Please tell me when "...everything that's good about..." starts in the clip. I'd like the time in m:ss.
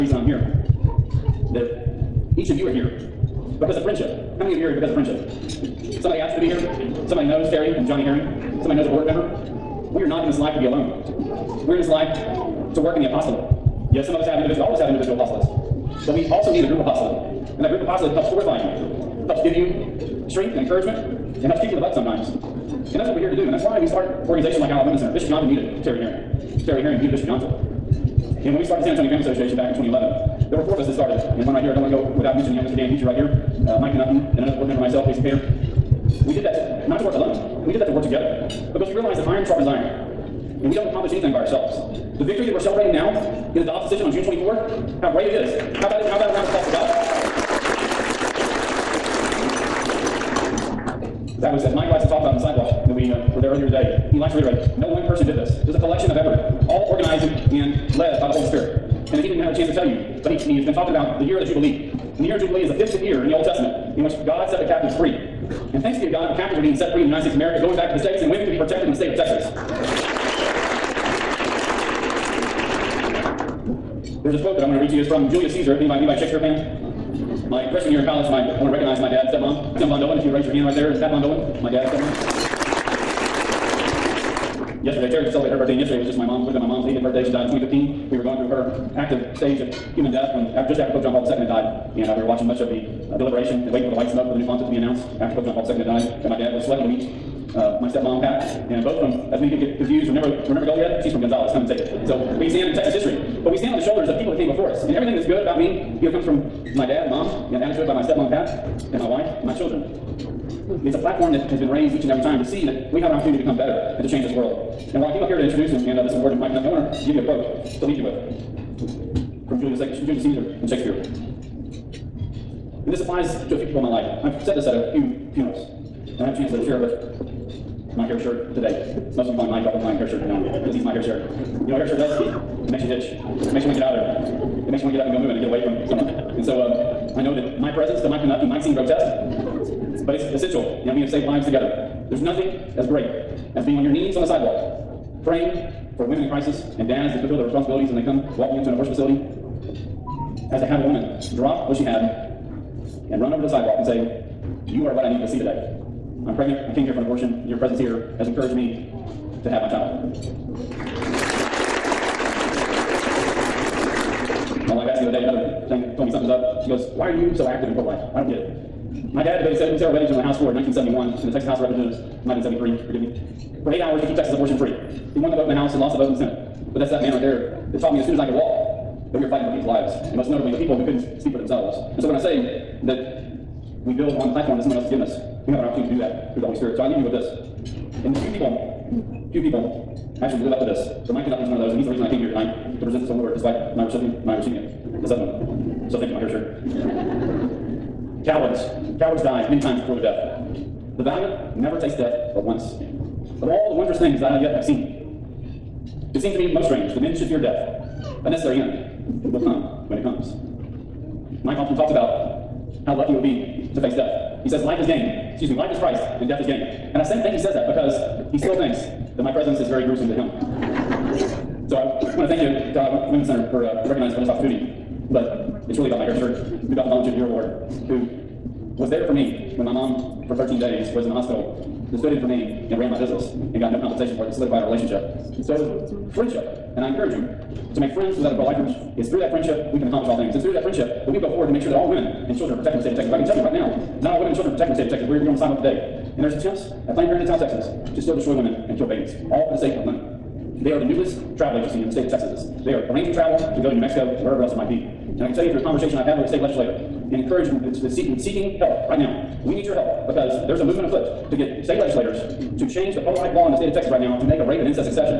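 1:44.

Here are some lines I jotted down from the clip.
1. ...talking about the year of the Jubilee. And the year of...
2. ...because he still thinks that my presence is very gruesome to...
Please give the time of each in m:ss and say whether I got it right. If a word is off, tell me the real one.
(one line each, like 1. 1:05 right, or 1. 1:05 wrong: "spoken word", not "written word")
1. 1:00 right
2. 3:37 right.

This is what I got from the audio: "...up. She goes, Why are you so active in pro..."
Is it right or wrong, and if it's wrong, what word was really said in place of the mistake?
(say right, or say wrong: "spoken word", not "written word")
right.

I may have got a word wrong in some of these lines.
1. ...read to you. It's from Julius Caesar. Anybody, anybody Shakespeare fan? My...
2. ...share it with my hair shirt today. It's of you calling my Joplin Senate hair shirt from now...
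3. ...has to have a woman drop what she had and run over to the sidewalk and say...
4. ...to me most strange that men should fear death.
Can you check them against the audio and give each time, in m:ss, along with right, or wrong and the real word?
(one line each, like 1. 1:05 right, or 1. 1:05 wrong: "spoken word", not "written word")
1. 1:14 right
2. 2:06 wrong: "Time", not "Senate"
3. 2:30 right
4. 3:26 right.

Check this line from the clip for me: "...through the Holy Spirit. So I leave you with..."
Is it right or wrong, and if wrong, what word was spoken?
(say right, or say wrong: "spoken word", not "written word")
right.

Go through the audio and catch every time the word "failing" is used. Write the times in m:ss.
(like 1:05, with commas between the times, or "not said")
not said.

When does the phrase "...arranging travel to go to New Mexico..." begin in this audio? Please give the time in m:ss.
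4:12.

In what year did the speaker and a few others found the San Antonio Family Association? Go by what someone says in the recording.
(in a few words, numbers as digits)
2011.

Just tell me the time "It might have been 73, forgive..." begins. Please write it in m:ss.
2:51.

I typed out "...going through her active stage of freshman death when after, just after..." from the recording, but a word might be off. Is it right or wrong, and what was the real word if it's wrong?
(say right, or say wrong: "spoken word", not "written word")
wrong: "human", not "freshman".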